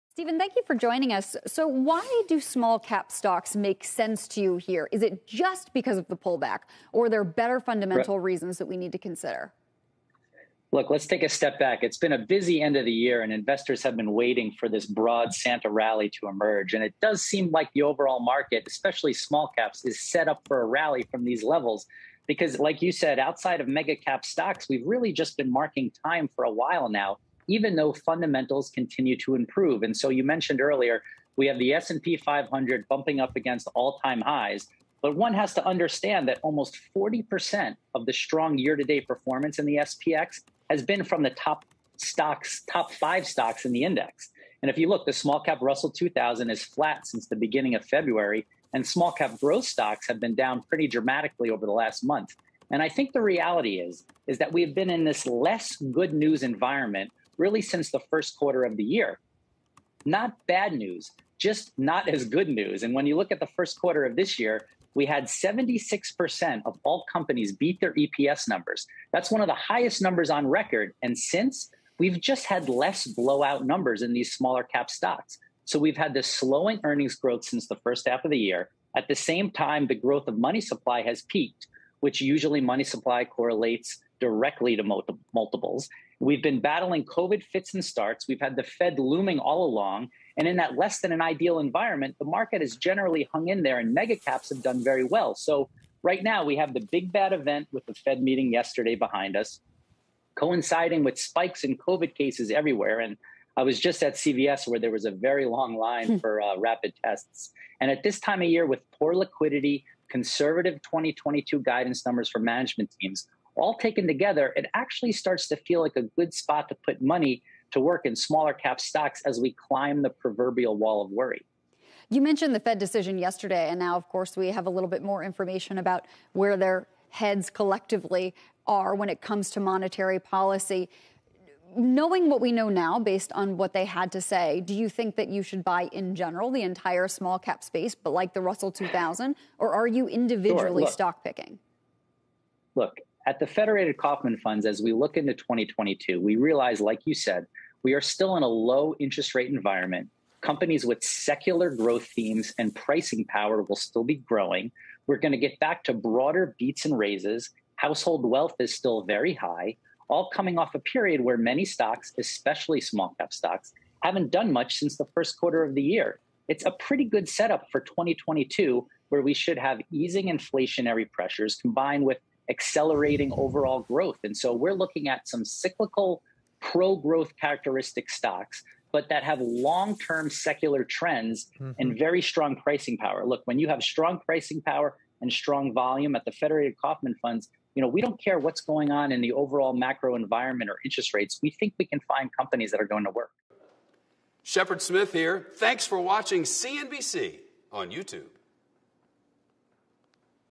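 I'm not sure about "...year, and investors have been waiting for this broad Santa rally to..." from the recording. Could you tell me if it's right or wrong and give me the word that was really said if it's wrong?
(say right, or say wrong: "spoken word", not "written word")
right.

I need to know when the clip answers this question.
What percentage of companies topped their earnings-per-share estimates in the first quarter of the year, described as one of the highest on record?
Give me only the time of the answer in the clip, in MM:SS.
01:05.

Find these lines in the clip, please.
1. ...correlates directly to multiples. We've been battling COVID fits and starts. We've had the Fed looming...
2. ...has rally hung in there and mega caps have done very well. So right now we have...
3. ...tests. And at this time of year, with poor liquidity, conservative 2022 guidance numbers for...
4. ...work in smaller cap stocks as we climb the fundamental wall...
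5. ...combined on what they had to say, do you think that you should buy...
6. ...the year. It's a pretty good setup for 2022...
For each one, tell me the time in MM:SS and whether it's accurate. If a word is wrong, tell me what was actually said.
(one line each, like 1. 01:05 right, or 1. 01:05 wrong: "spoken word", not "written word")
1. 01:23 right
2. 01:32 wrong: "generally", not "rally"
3. 01:47 right
4. 01:57 wrong: "proverbial", not "fundamental"
5. 02:12 wrong: "based", not "combined"
6. 02:45 right.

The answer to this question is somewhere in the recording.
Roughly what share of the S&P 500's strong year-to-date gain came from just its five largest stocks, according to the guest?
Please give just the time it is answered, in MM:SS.
00:36.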